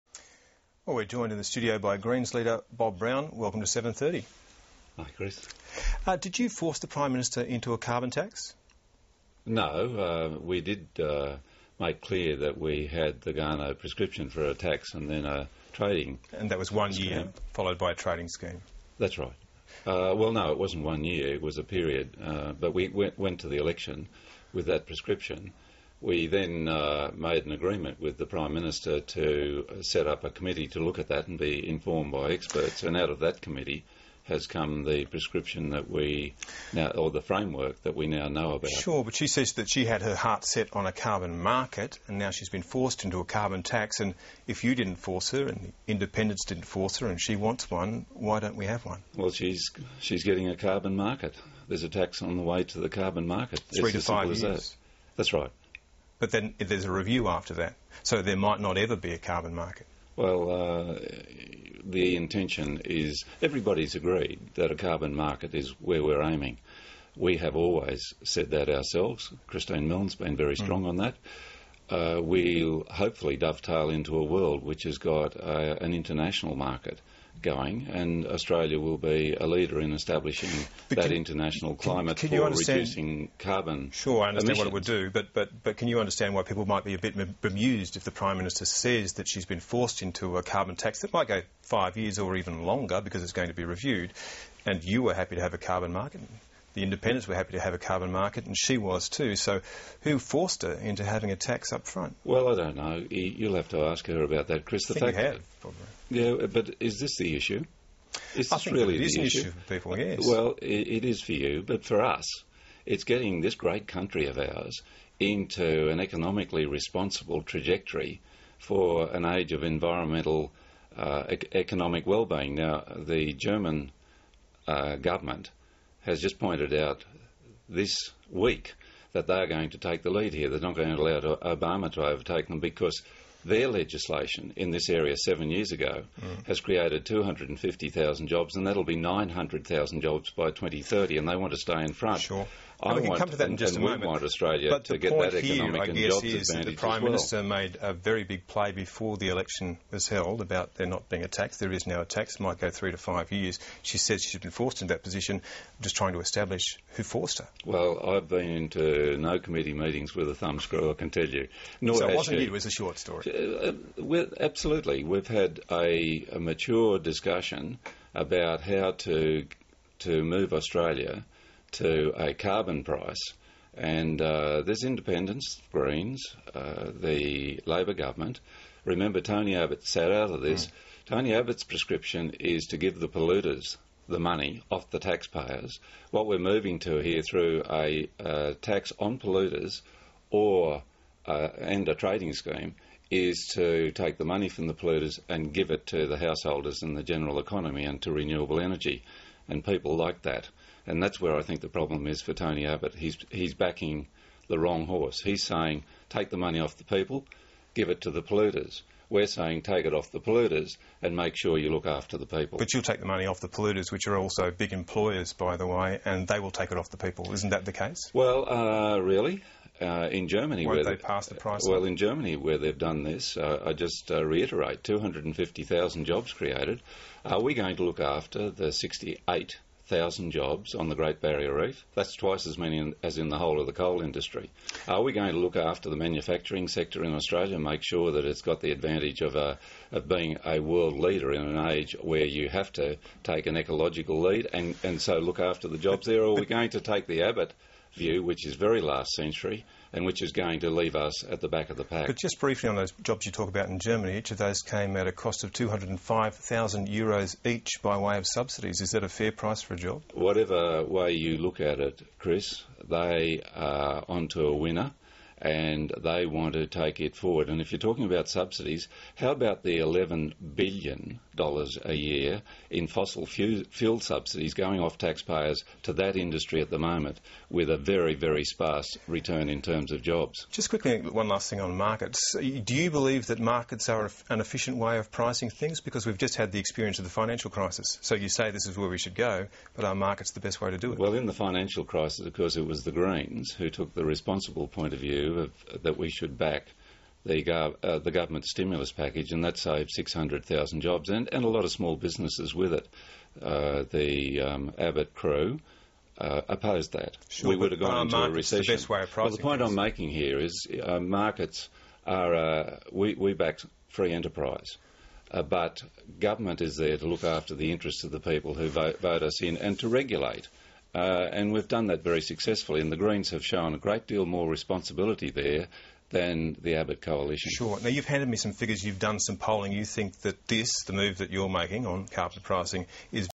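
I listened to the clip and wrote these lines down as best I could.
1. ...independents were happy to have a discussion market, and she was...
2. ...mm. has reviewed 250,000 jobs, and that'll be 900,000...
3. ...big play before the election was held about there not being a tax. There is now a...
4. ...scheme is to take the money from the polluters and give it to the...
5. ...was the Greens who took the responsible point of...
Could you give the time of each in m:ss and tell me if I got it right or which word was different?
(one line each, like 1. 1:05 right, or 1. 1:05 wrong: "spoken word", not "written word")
1. 1:36 wrong: "carbon", not "discussion"
2. 2:16 wrong: "created", not "reviewed"
3. 2:28 right
4. 3:12 right
5. 4:52 right.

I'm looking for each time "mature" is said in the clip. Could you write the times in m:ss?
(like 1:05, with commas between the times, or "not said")
2:46.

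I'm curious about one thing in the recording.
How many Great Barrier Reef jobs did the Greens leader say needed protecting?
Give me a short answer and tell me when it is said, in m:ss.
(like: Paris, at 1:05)
68,000, at 3:48.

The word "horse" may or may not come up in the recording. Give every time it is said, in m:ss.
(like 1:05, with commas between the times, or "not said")
3:24.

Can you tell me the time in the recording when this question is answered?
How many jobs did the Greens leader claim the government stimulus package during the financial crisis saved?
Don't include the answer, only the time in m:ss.
4:59.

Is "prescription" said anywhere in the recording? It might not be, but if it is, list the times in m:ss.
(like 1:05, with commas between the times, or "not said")
0:13, 0:24, 0:35, 3:01.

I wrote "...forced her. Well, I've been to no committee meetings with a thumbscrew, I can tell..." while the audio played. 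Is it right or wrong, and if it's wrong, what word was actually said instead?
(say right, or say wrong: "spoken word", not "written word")
right.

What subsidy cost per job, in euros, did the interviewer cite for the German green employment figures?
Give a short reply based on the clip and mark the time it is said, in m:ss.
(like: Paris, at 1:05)
205,000 euros, at 4:15.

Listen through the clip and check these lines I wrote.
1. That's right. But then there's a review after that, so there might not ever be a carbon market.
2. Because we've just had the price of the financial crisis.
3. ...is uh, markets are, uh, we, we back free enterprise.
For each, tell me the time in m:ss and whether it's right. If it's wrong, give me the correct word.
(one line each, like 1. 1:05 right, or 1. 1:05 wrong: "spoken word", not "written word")
1. 0:55 right
2. 4:45 wrong: "experience", not "price"
3. 5:10 right.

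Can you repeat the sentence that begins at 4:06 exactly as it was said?
Or are we going to take the Abbott?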